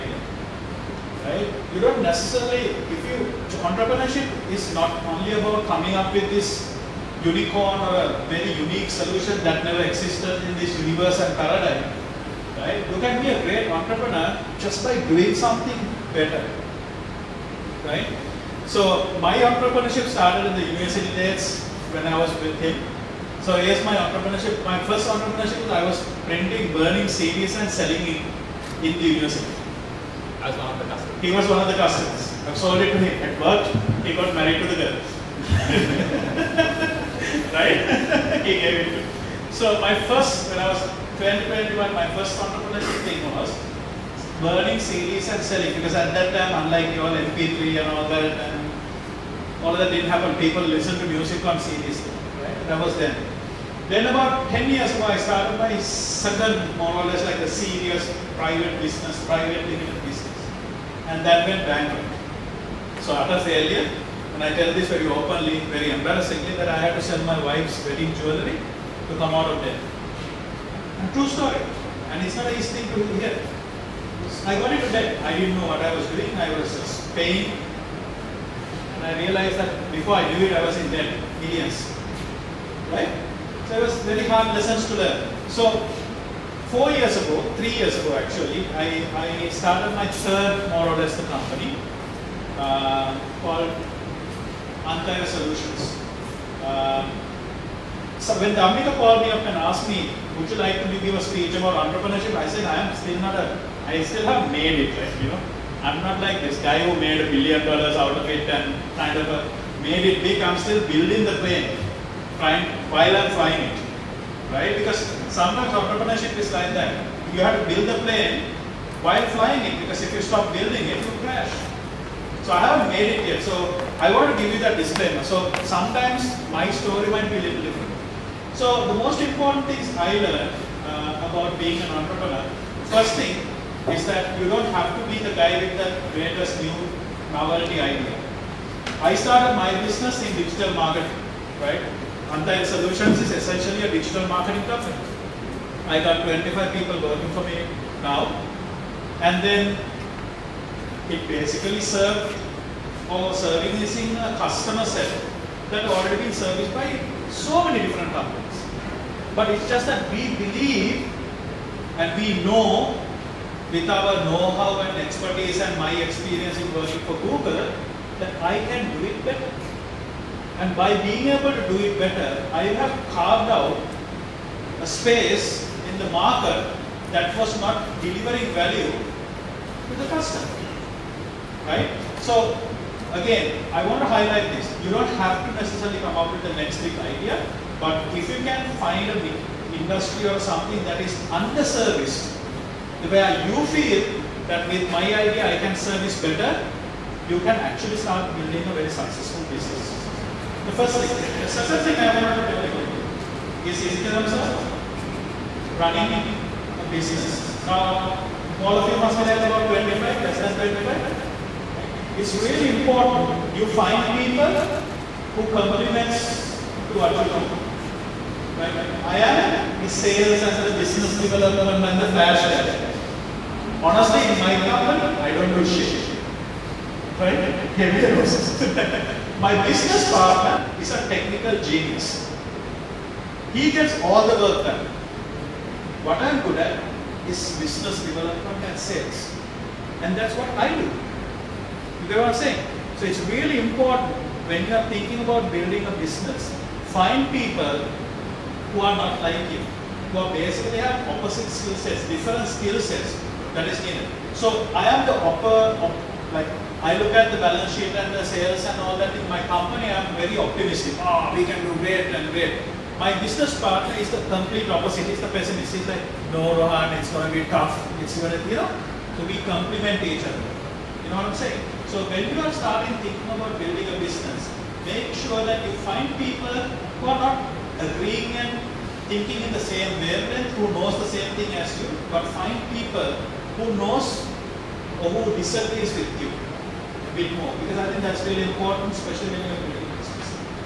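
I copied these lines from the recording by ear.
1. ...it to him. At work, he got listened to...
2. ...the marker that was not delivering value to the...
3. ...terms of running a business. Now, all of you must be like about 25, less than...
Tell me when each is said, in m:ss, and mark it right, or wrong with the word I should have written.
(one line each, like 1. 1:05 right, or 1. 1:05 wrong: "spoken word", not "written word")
1. 0:32 wrong: "married", not "listened"
2. 2:56 right
3. 3:24 right.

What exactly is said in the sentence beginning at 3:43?
Honestly, in my company, I don't do shit.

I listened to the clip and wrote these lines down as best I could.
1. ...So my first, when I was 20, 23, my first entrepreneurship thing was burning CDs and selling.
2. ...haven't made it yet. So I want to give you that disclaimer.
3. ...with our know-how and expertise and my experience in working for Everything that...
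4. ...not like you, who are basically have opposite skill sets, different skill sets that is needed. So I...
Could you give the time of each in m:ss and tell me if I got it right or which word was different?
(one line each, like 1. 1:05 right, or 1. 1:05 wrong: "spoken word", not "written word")
1. 0:39 wrong: "21", not "23"
2. 2:02 right
3. 2:43 wrong: "Google", not "Everything"
4. 4:09 right.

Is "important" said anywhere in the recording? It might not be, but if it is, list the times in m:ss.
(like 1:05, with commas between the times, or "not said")
2:09, 3:32, 4:03, 4:48.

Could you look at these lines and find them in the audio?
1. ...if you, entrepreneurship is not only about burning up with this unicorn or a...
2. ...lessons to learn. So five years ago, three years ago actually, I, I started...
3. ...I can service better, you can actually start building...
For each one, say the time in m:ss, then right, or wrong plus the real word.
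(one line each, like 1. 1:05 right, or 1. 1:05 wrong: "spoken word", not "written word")
1. 0:02 wrong: "coming", not "burning"
2. 1:24 wrong: "four", not "five"
3. 3:15 right.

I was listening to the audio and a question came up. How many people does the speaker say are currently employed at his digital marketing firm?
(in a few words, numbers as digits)
25.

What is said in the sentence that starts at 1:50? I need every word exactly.
I'm still building the plane, trying, while I'm flying it, right?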